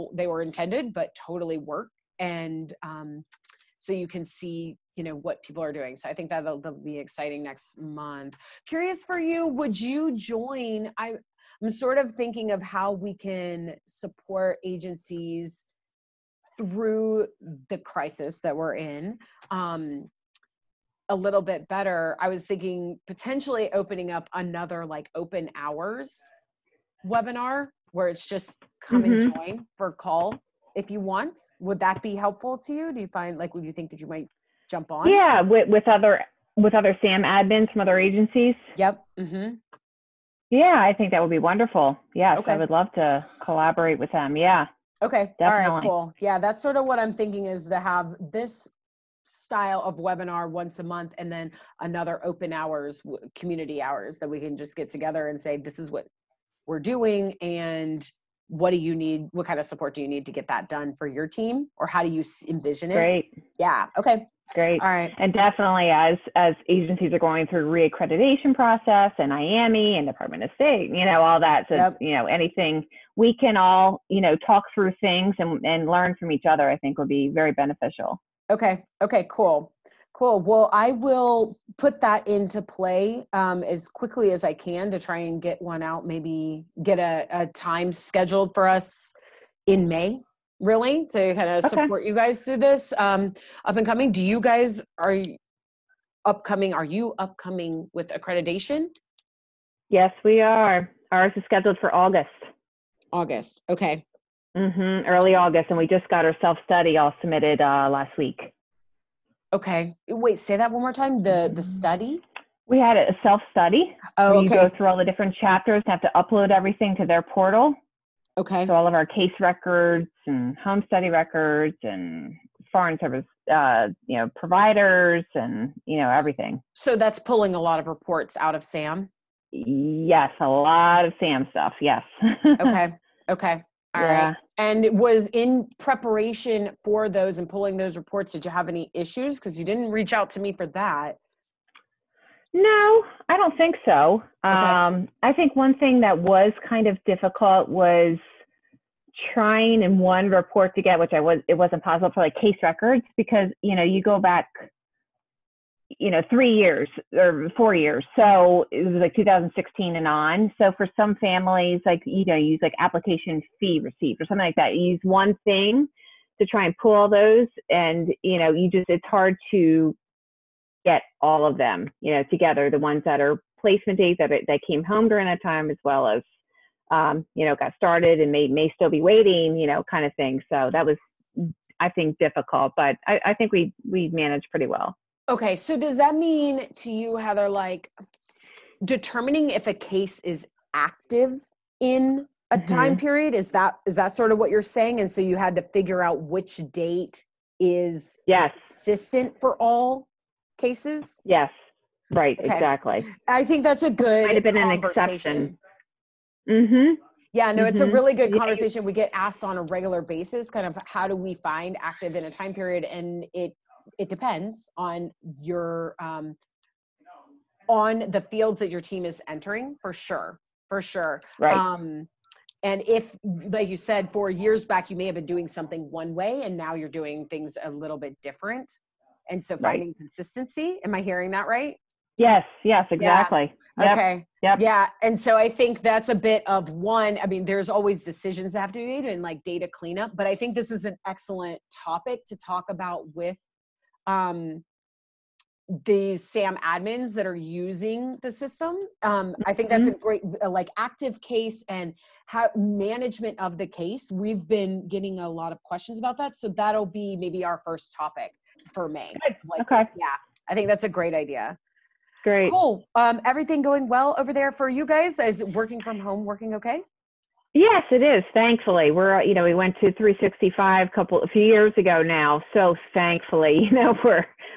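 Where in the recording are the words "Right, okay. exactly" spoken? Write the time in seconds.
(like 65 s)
202 s.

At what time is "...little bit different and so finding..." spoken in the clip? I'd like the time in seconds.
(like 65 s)
227 s.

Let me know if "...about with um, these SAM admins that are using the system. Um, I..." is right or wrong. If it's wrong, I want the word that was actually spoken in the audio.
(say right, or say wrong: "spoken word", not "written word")
right.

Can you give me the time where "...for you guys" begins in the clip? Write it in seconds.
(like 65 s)
264 s.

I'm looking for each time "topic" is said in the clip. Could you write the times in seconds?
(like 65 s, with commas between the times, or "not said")
241 s, 257 s.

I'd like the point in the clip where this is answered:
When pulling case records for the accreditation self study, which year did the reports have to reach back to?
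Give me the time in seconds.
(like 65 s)
159 s.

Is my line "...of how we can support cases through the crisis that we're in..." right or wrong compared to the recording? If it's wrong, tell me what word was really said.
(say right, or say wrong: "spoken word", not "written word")
wrong: "agencies", not "cases".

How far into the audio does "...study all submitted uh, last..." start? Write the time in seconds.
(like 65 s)
106 s.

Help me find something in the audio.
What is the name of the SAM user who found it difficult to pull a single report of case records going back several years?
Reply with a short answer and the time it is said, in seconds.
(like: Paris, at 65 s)
Heather, at 187 s.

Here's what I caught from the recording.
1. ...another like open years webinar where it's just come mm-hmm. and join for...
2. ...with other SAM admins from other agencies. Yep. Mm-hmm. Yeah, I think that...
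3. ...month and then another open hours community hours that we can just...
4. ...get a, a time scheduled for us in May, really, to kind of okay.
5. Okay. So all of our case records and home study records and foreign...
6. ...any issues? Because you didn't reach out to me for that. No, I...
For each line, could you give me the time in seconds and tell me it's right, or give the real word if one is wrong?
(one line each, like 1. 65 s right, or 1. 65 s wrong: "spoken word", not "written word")
1. 24 s wrong: "hours", not "years"
2. 36 s right
3. 50 s right
4. 86 s right
5. 118 s right
6. 138 s right.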